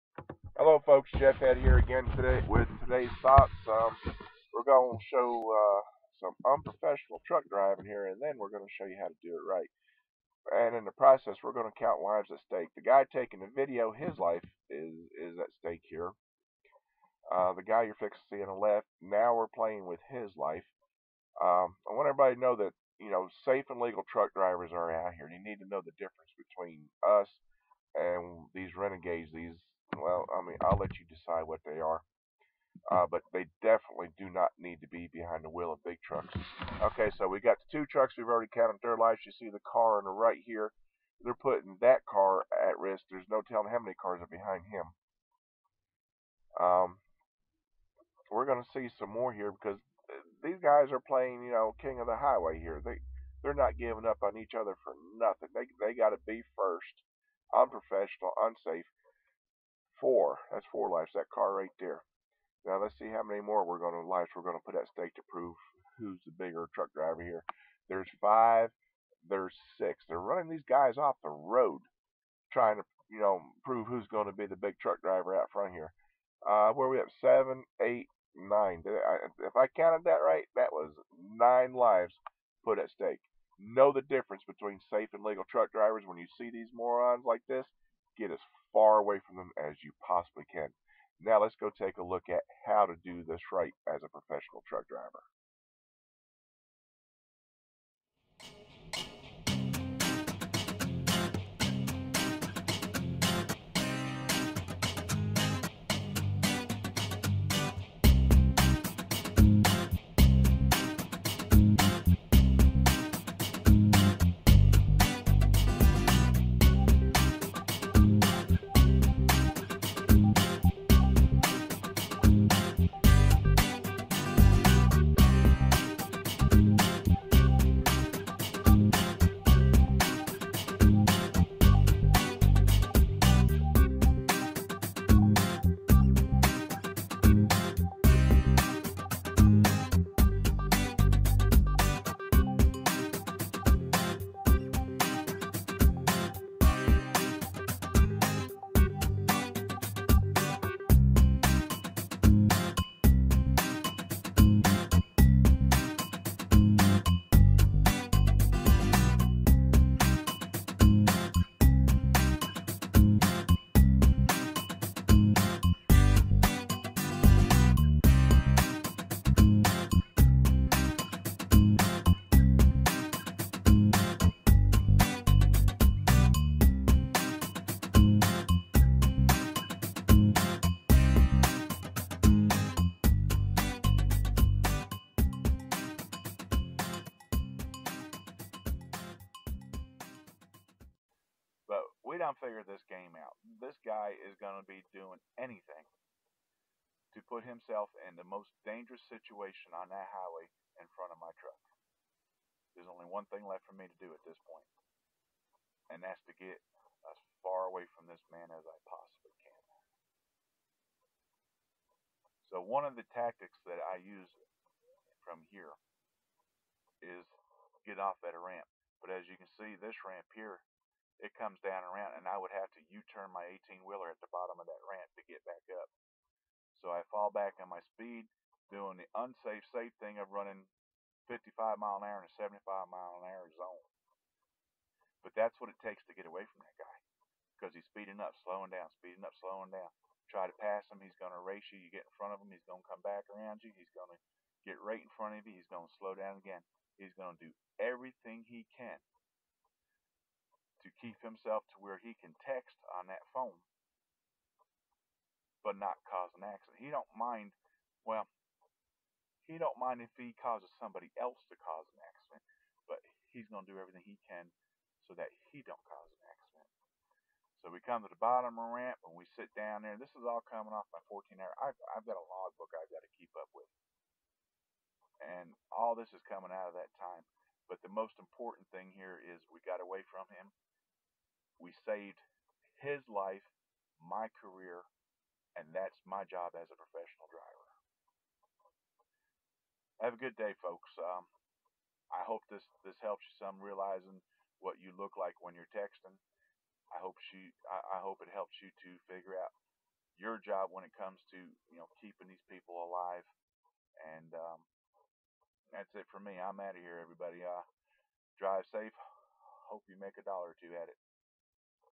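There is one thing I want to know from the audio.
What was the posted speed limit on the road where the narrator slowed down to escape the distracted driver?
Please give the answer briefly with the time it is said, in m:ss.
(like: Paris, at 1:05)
75 mph, at 3:52.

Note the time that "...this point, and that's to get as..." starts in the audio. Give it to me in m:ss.
3:24.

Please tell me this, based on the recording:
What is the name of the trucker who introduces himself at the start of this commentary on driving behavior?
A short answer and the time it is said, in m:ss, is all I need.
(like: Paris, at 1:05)
Jeff Head, at 0:01.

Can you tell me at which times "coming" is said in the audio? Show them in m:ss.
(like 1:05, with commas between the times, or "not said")
4:30, 4:36.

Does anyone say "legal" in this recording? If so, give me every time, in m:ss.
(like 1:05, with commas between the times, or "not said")
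0:23, 1:25.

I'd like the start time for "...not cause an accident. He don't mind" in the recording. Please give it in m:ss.
4:15.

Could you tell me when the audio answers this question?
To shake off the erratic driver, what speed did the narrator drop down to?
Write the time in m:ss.
3:51.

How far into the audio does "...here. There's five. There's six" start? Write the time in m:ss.
1:07.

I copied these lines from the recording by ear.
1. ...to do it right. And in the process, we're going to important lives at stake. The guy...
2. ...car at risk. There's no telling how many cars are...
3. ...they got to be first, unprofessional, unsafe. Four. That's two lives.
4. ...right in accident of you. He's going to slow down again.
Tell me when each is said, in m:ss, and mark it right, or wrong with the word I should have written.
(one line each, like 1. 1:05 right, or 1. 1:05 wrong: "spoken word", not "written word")
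1. 0:09 wrong: "count", not "important"
2. 0:42 right
3. 0:55 wrong: "four", not "two"
4. 4:04 wrong: "front", not "accident".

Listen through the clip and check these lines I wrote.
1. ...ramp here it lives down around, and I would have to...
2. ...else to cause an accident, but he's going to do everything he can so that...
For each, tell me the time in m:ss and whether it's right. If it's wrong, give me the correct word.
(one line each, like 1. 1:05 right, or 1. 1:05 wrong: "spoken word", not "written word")
1. 3:40 wrong: "comes", not "lives"
2. 4:21 right.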